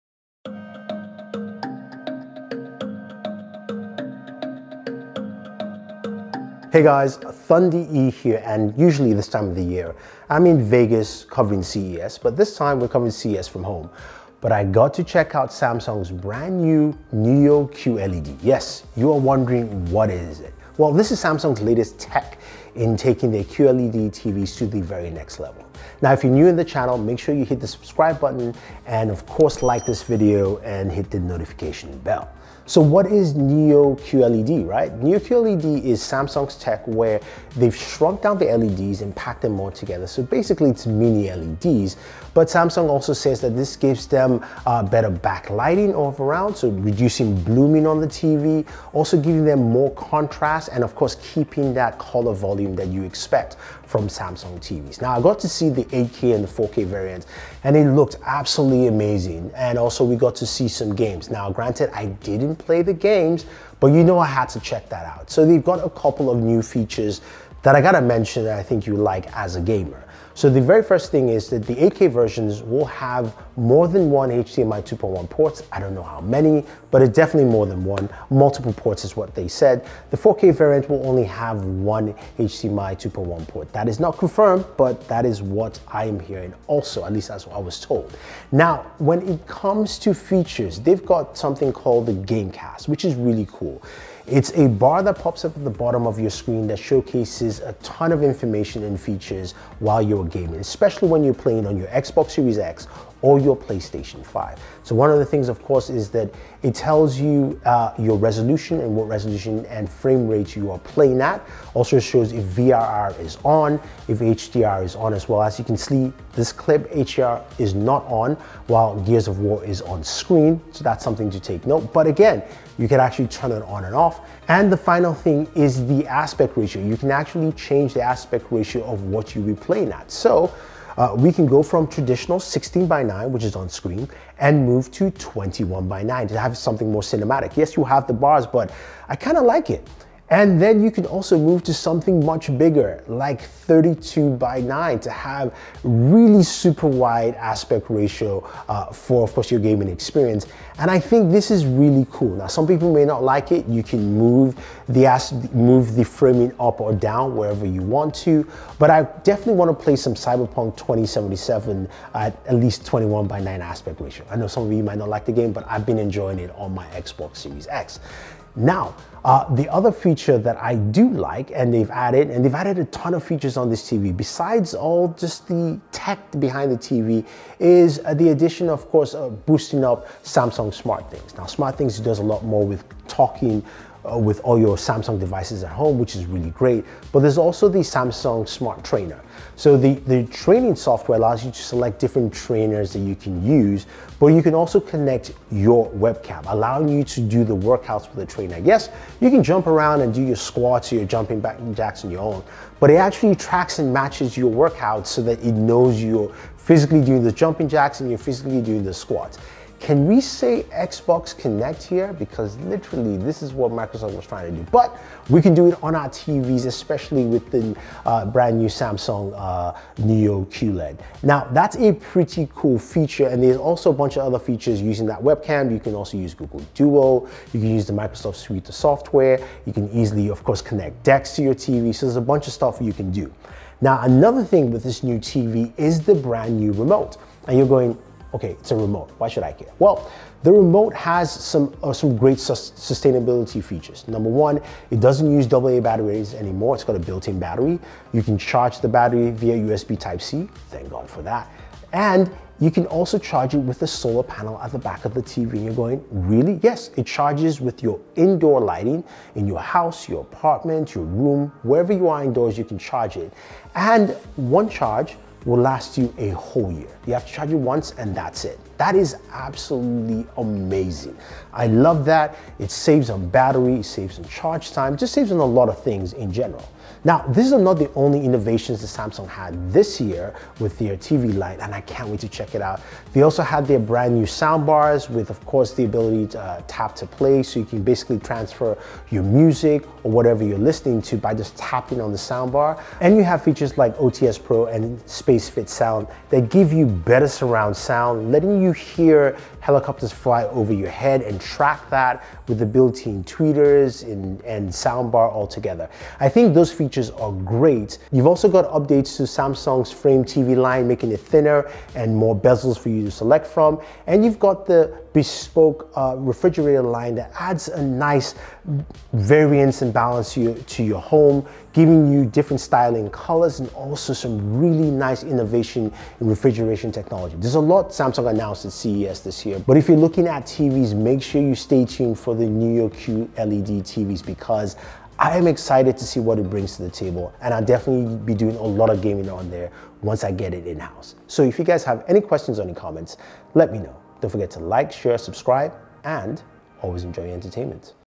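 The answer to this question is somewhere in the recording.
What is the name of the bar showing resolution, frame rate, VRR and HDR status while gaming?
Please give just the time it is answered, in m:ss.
1:32.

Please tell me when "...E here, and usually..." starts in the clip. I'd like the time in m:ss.
0:07.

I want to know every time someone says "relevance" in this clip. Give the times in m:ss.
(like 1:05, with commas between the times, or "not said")
not said.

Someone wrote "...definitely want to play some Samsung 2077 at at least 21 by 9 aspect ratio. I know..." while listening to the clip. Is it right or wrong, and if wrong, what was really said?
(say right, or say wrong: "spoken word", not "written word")
wrong: "Cyberpunk", not "Samsung".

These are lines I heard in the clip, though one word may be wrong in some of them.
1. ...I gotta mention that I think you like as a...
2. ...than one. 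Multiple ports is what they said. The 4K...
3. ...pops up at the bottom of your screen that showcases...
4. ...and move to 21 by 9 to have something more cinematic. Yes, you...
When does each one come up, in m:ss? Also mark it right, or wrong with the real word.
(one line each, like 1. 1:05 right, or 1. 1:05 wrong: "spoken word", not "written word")
1. 1:07 right
2. 1:17 right
3. 1:35 right
4. 2:14 right.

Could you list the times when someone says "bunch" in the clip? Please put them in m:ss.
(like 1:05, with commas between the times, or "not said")
3:43, 3:52.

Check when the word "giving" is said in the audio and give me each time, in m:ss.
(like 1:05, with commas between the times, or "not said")
0:49, 5:21.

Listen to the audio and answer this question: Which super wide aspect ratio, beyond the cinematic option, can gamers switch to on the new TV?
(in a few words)
32 by 9.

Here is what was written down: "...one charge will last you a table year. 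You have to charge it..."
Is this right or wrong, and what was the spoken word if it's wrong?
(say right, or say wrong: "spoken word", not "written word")
wrong: "whole", not "table".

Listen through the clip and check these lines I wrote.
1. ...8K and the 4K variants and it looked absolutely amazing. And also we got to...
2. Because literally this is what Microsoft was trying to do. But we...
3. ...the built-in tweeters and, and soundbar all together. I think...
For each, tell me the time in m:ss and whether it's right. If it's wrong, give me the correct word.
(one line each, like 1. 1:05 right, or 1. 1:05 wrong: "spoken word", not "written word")
1. 0:55 right
2. 3:32 right
3. 5:02 right.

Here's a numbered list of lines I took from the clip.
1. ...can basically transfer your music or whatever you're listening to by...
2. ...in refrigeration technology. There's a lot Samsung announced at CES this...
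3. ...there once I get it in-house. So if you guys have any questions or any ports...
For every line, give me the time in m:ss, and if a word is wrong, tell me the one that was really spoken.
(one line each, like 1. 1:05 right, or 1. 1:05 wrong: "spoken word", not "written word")
1. 4:47 right
2. 5:26 right
3. 5:39 wrong: "comments", not "ports".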